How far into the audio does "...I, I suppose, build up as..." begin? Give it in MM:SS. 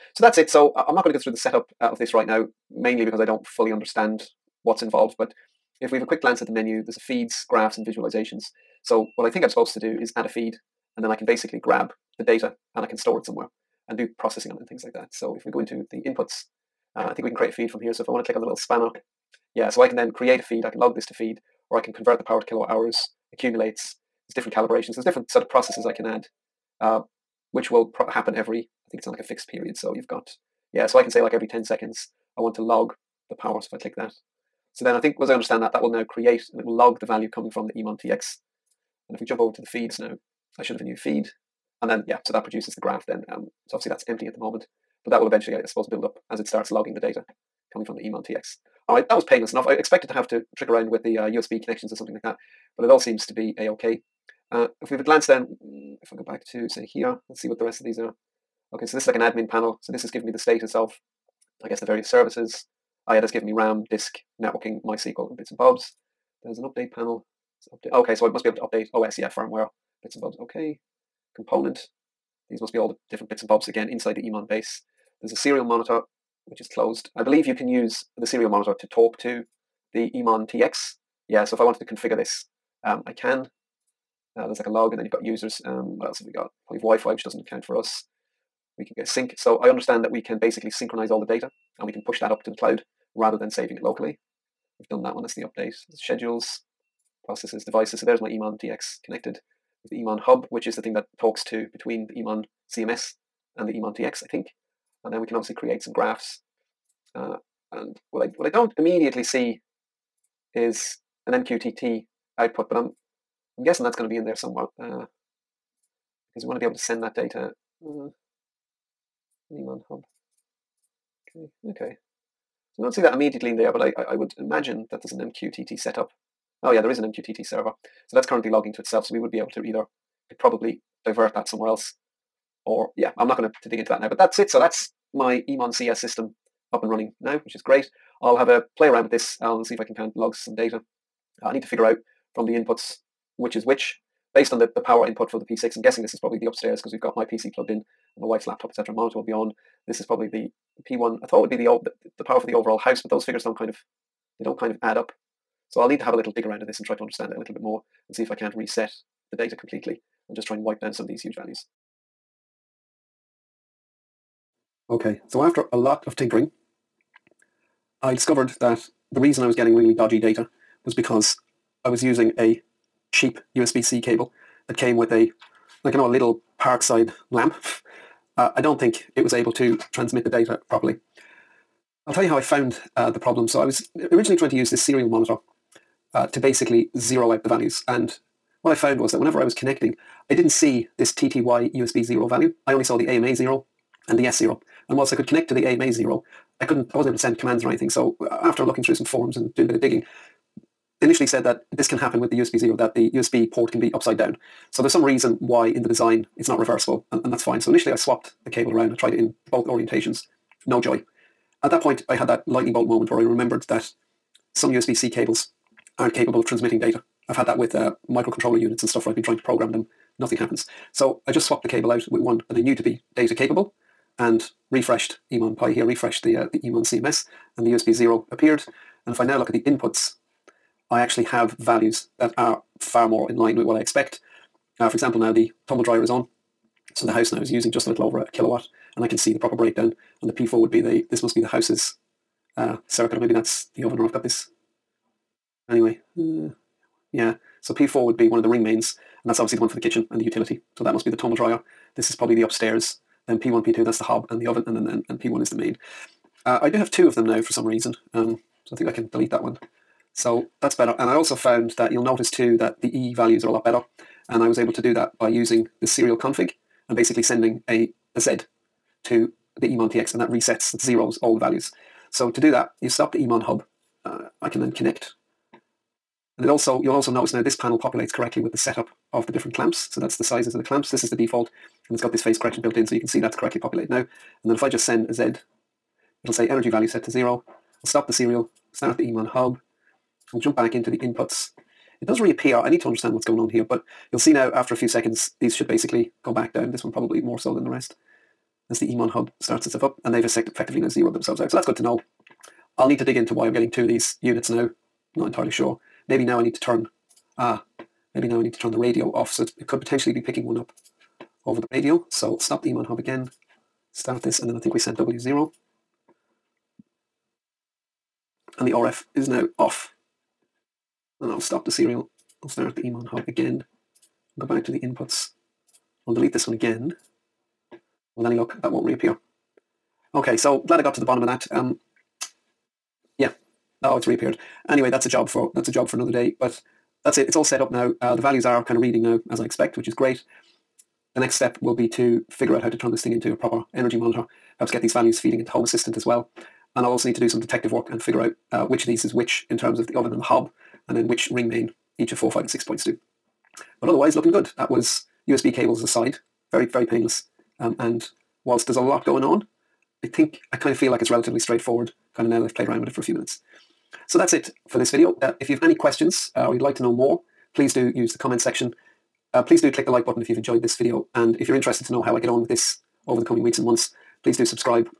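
00:45.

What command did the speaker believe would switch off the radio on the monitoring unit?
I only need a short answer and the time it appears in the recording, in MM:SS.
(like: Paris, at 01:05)
W0, at 05:14.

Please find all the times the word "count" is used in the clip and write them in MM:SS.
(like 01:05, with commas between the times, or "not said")
01:27, 02:19.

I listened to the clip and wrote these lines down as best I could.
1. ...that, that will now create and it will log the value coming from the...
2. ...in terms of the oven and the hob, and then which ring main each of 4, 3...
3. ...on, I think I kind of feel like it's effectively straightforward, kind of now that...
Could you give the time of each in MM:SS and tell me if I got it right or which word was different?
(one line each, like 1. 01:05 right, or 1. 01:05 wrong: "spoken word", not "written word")
1. 00:35 right
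2. 05:49 wrong: "5", not "3"
3. 05:59 wrong: "relatively", not "effectively".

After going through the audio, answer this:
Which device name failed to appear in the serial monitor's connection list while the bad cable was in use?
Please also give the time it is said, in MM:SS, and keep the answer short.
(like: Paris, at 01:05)
TTY USB 0, at 03:11.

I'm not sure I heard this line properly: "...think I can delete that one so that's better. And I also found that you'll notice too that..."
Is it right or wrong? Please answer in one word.
right.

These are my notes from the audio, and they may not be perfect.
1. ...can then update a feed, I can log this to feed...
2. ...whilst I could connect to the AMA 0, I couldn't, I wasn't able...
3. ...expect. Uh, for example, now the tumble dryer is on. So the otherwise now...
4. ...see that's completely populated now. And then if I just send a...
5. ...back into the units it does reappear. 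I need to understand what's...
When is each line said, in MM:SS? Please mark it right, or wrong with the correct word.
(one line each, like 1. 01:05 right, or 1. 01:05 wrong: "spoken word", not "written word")
1. 00:19 wrong: "create", not "update"
2. 03:14 right
3. 03:53 wrong: "house", not "otherwise"
4. 04:43 wrong: "correctly", not "completely"
5. 04:50 wrong: "inputs", not "units".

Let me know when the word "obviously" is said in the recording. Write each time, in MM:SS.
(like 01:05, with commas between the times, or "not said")
00:43, 01:45, 04:09.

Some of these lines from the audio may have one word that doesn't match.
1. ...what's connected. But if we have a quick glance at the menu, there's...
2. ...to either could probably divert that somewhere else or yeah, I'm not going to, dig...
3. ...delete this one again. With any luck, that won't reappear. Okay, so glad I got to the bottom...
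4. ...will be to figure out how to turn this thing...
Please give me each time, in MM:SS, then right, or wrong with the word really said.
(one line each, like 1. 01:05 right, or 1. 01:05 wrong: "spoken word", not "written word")
1. 00:04 wrong: "involved", not "connected"
2. 02:09 right
3. 05:26 right
4. 05:41 right.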